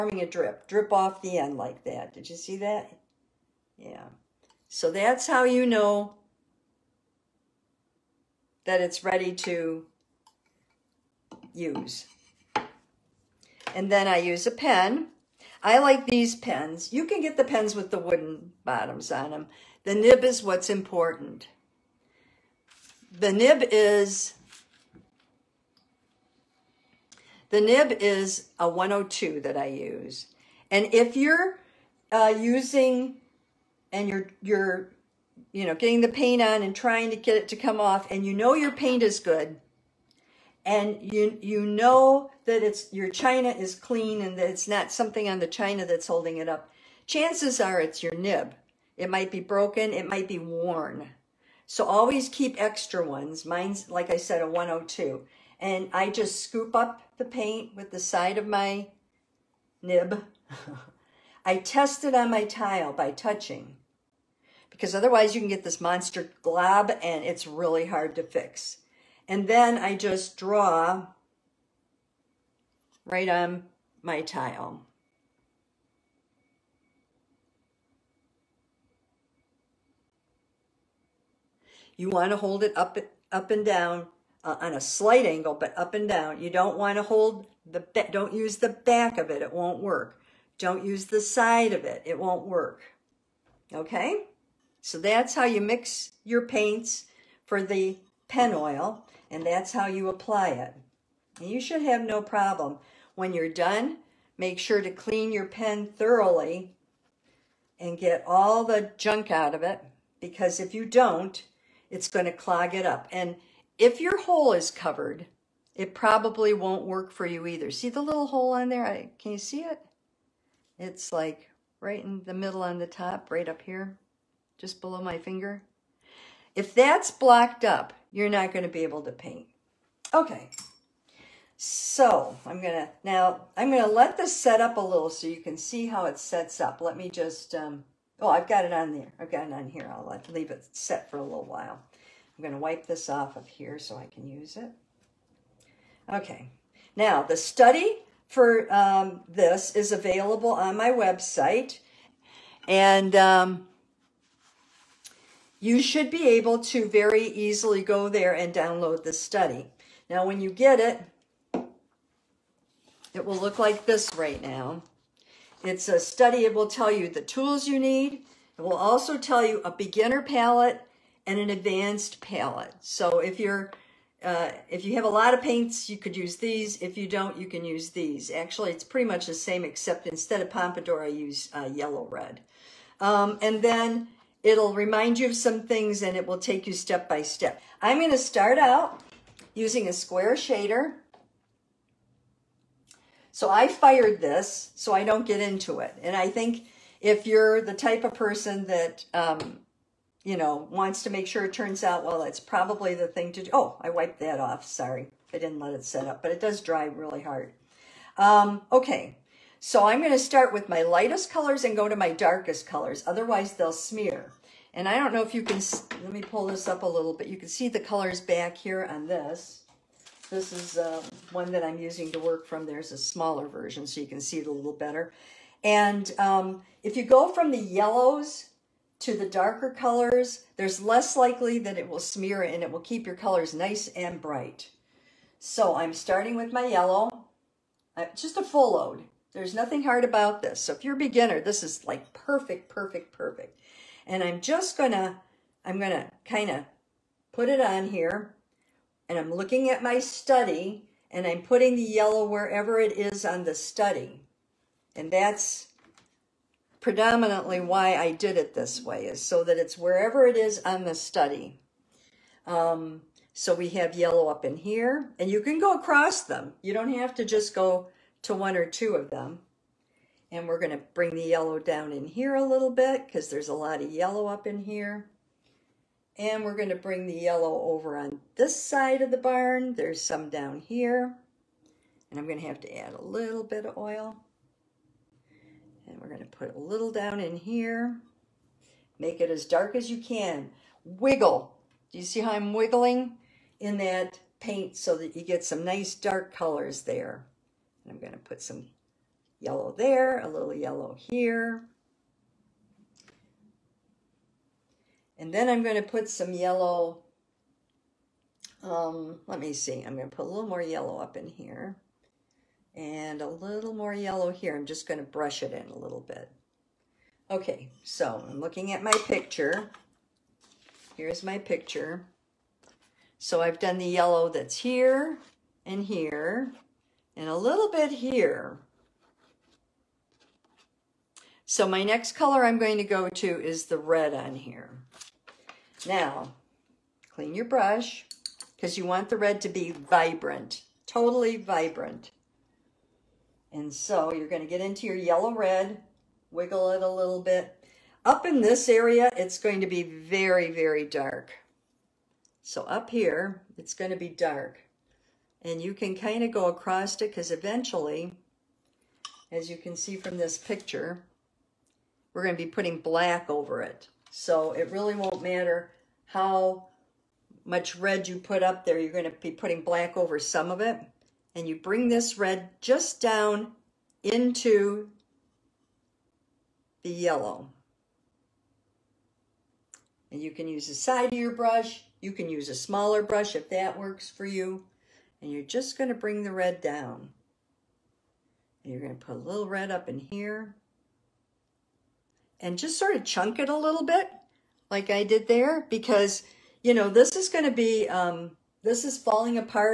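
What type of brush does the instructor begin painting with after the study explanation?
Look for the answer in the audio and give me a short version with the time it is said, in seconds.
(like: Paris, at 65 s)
square shader, at 189 s.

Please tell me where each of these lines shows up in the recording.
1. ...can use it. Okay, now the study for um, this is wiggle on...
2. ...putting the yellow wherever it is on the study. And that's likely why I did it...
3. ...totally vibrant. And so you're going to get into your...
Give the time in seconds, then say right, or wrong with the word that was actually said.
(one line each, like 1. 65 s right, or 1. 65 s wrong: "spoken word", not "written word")
1. 144 s wrong: "available", not "wiggle"
2. 251 s wrong: "predominantly", not "likely"
3. 340 s right.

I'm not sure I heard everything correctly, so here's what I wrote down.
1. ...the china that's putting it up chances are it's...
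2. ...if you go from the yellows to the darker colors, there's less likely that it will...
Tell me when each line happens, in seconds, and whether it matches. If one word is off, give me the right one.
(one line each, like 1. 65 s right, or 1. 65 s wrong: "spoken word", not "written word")
1. 45 s wrong: "holding", not "putting"
2. 226 s right.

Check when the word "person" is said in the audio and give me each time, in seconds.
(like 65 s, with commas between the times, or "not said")
198 s.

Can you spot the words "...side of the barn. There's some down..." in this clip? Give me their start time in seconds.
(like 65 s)
278 s.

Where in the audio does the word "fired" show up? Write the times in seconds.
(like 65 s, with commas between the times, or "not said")
193 s.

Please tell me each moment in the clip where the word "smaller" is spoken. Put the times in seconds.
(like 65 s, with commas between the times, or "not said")
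222 s, 382 s.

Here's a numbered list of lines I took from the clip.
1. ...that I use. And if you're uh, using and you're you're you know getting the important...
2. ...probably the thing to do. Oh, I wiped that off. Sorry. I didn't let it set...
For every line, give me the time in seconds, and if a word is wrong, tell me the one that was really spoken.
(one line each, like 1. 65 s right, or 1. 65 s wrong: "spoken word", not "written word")
1. 29 s wrong: "paint", not "important"
2. 202 s right.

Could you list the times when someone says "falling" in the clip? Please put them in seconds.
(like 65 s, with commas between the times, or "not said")
398 s.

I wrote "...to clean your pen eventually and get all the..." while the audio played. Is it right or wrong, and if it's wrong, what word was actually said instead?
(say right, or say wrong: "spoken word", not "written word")
wrong: "thoroughly", not "eventually".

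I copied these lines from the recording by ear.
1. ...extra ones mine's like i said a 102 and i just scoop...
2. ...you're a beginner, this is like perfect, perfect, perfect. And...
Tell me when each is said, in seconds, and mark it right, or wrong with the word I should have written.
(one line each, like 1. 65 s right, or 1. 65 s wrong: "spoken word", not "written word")
1. 52 s right
2. 240 s right.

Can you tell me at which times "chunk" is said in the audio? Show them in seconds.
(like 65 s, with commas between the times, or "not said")
393 s.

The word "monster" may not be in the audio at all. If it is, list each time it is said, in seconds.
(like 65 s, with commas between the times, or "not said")
65 s.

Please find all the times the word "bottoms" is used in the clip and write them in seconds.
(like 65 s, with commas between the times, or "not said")
18 s.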